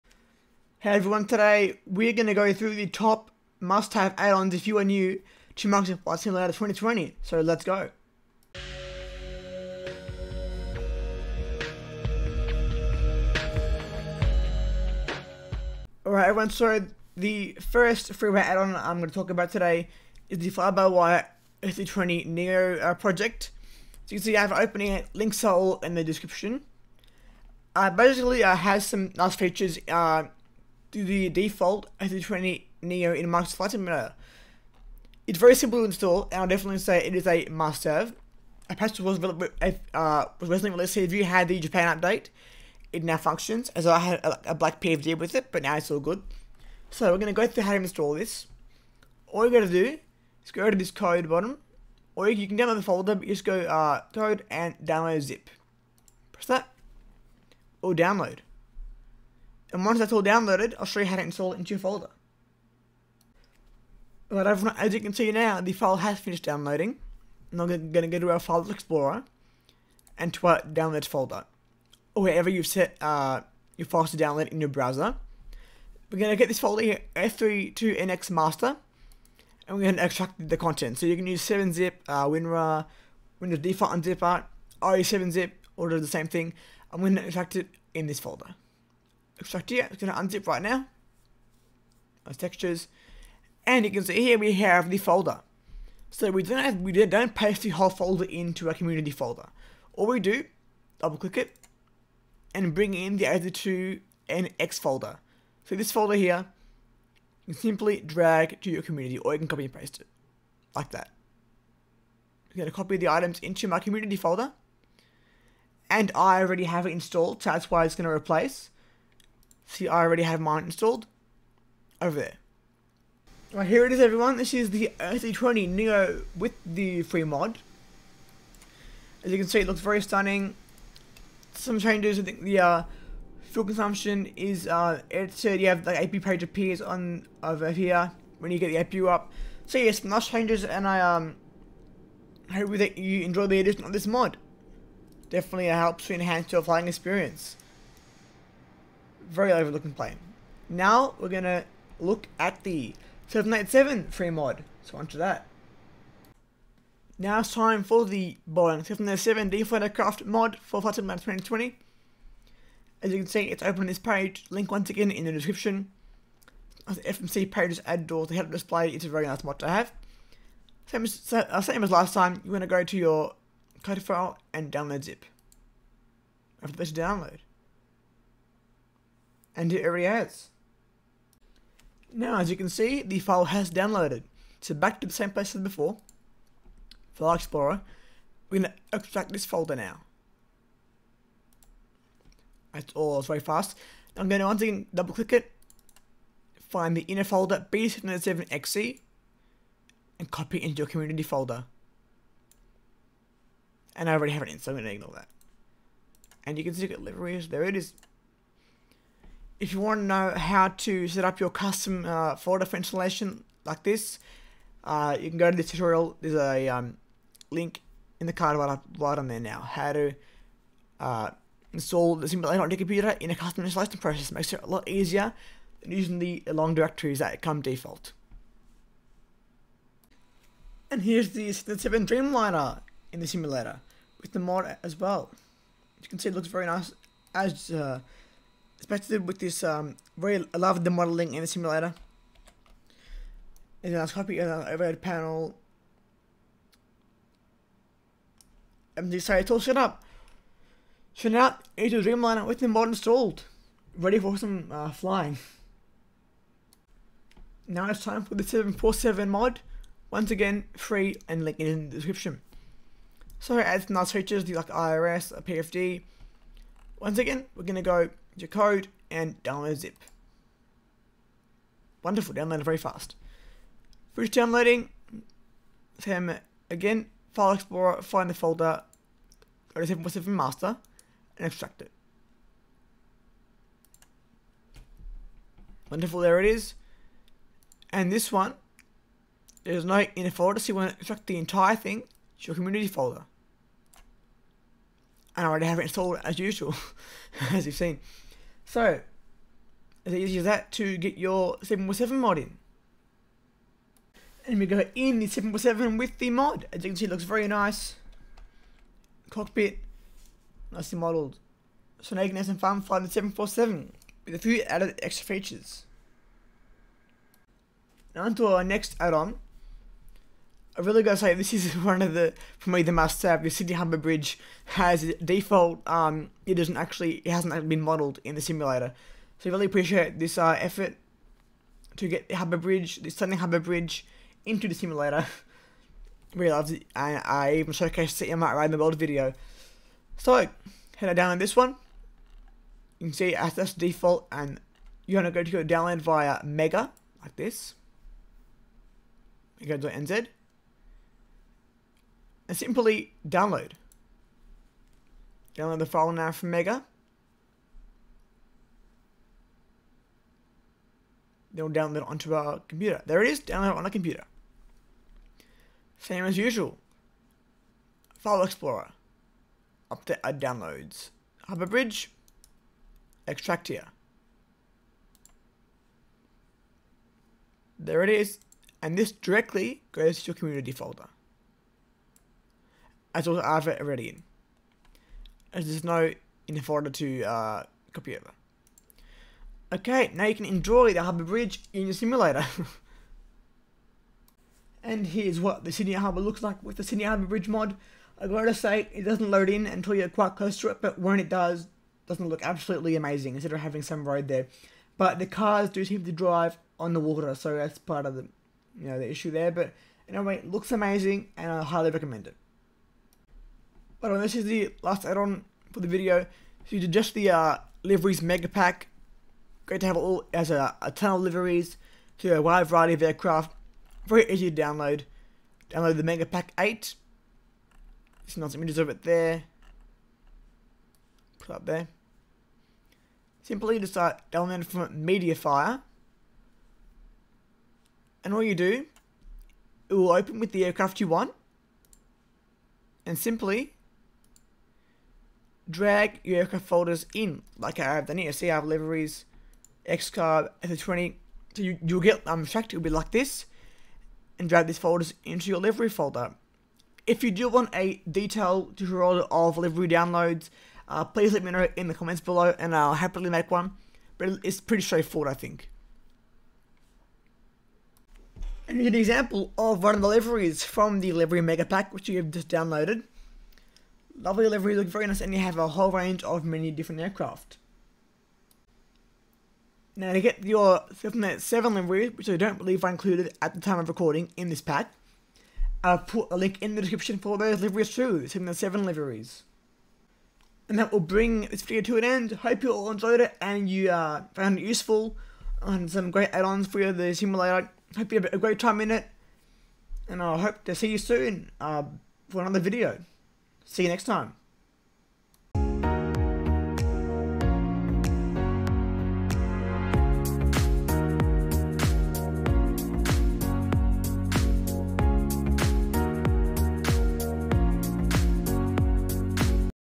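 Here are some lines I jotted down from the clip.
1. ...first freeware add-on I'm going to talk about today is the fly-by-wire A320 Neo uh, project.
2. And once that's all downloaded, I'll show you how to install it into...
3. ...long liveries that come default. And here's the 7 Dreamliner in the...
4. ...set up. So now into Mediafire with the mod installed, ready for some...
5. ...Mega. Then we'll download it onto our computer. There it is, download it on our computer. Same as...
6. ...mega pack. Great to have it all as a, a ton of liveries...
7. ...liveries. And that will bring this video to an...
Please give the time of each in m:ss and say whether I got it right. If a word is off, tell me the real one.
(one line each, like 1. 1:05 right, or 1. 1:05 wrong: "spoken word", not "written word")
1. 0:17 right
2. 0:59 right
3. 3:46 wrong: "directories", not "liveries"
4. 4:09 wrong: "Dreamliner", not "Mediafire"
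5. 5:56 right
6. 6:58 right
7. 8:08 right.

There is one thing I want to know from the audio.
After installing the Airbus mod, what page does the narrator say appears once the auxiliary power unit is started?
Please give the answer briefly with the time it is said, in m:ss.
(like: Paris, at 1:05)
AP page, at 2:16.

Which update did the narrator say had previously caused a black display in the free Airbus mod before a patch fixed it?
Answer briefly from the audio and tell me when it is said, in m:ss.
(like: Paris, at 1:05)
Japan update, at 0:41.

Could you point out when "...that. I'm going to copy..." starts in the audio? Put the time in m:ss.
1:50.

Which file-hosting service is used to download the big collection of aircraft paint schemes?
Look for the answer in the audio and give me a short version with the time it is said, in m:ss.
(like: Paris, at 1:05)
Mediafire, at 7:15.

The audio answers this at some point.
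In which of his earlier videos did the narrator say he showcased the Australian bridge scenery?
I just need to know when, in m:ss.
5:38.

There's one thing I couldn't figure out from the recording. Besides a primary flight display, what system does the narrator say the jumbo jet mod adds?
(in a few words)
IRS.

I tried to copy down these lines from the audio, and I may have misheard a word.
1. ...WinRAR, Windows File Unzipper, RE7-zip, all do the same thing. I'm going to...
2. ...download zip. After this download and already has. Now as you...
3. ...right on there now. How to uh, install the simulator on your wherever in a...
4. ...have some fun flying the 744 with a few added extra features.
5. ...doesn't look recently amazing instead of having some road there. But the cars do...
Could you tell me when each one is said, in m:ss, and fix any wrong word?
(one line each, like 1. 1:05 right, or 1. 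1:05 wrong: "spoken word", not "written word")
1. 1:22 wrong: "Default", not "File"
2. 2:54 right
3. 3:38 wrong: "computer", not "wherever"
4. 5:12 wrong: "747", not "744"
5. 6:42 wrong: "absolutely", not "recently".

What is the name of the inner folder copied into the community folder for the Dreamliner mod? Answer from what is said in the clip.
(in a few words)
b 7 xe.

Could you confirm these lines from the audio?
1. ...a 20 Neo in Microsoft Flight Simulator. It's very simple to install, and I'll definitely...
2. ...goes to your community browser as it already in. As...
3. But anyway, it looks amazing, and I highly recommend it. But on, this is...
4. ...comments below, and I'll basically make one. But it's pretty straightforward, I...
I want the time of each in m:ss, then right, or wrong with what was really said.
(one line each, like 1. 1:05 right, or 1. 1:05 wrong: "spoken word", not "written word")
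1. 0:31 right
2. 6:19 wrong: "folder", not "browser"
3. 6:49 right
4. 7:41 wrong: "happily", not "basically".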